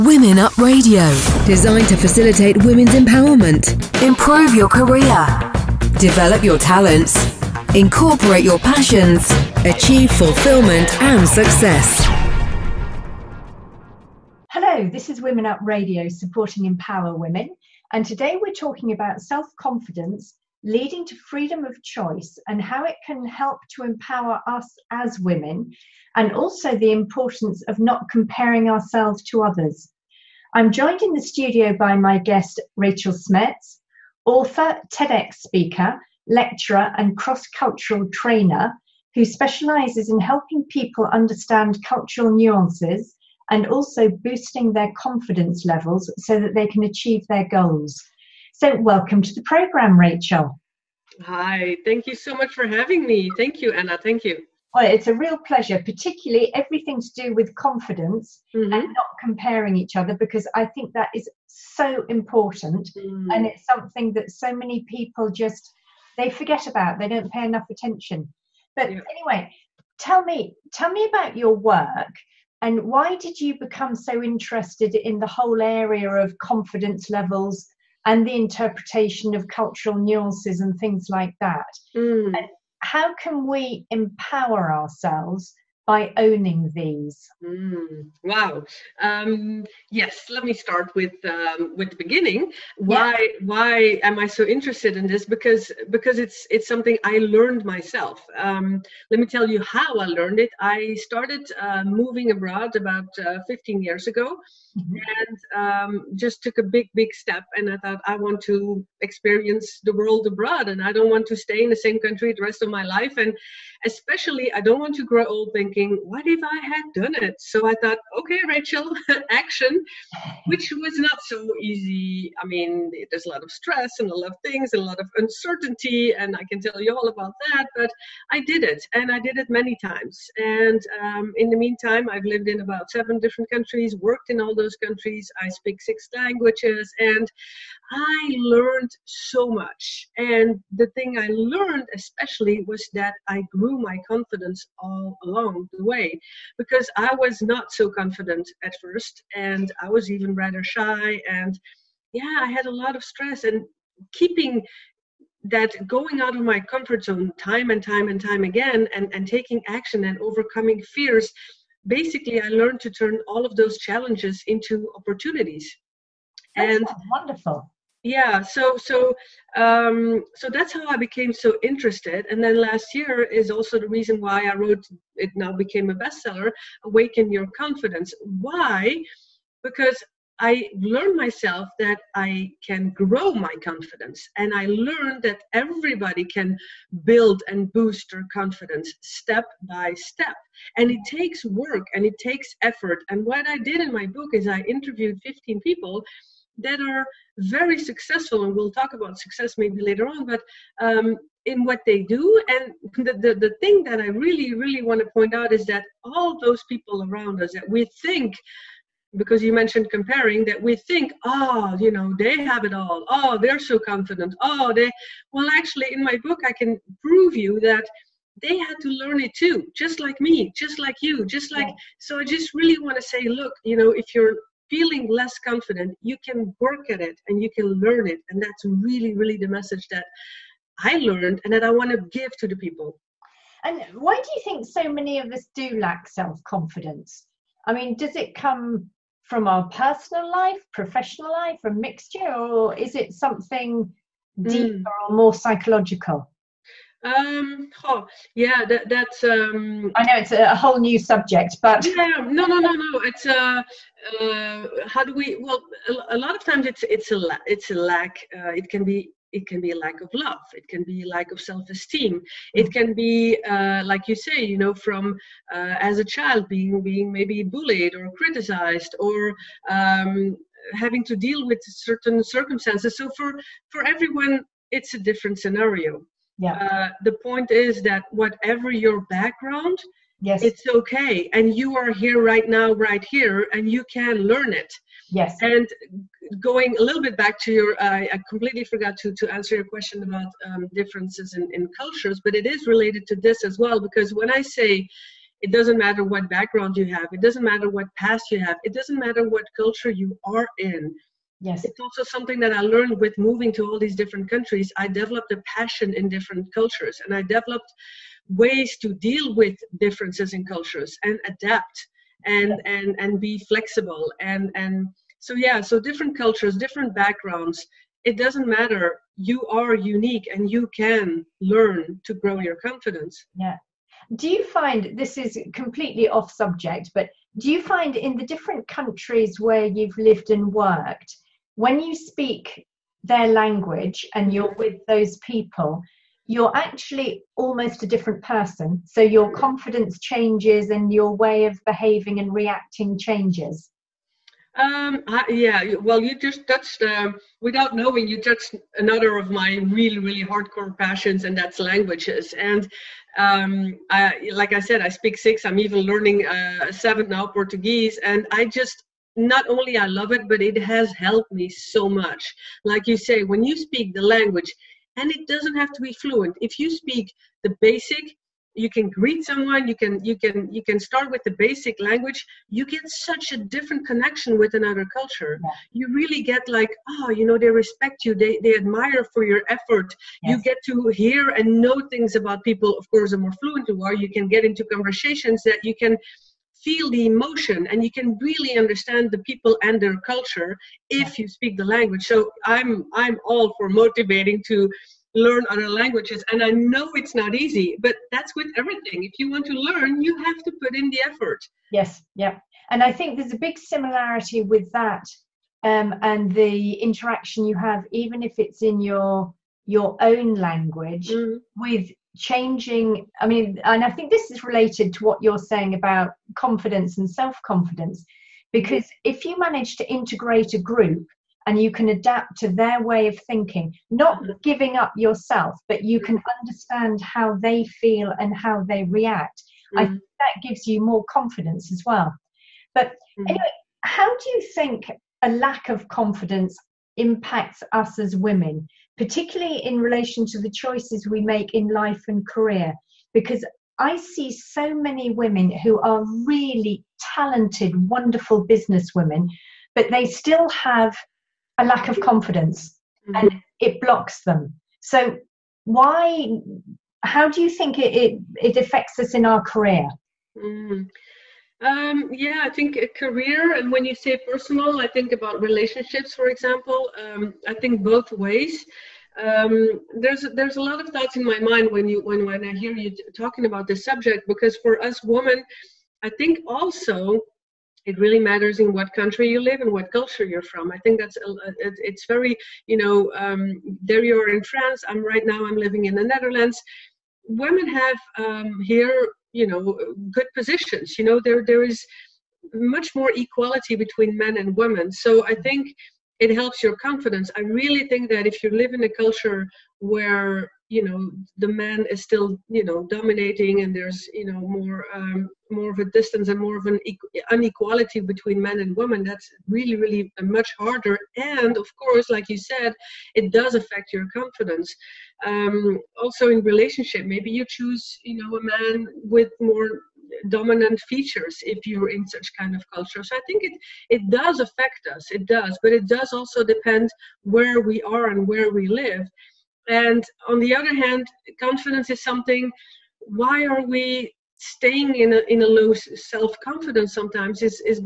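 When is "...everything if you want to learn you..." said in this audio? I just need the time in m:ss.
6:38.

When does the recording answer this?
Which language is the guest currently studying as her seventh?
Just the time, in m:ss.
5:57.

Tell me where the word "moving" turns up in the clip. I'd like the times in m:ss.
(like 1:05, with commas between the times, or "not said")
1:41, 5:03.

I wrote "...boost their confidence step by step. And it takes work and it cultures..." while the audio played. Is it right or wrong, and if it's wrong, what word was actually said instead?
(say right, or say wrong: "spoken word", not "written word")
wrong: "takes", not "cultures".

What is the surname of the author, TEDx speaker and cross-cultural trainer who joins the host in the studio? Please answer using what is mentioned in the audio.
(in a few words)
Smets.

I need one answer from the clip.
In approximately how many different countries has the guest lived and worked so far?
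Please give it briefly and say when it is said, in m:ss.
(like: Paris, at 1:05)
7, at 2:12.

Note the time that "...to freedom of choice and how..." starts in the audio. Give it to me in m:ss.
0:21.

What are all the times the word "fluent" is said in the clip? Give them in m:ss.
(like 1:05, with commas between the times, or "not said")
6:05, 6:23.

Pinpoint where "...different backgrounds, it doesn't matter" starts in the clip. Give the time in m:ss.
5:16.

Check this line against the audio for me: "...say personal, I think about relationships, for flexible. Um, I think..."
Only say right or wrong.
wrong.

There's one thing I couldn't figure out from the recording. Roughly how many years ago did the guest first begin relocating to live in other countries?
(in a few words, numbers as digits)
15.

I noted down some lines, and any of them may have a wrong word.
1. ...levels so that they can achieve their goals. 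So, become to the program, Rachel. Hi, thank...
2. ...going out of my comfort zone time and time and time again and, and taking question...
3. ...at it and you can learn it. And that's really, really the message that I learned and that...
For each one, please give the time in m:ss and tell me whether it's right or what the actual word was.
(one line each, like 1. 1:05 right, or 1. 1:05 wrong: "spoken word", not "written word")
1. 0:45 wrong: "welcome", not "become"
2. 2:35 wrong: "action", not "question"
3. 3:46 right.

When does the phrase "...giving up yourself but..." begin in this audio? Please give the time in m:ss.
7:04.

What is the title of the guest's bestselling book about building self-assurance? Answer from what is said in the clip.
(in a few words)
Awaken Your Confidence.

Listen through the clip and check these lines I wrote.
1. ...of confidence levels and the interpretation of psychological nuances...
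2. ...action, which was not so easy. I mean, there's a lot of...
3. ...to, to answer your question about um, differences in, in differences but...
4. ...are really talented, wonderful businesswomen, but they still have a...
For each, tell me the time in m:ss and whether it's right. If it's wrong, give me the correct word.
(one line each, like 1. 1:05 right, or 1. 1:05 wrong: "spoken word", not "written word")
1. 1:16 wrong: "cultural", not "psychological"
2. 1:59 right
3. 4:49 wrong: "cultures", not "differences"
4. 7:25 right.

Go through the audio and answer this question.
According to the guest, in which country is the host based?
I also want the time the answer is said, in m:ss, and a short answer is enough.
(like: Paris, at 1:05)
France, at 8:04.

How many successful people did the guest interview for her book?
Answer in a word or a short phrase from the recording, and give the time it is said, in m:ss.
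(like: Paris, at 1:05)
15, at 3:15.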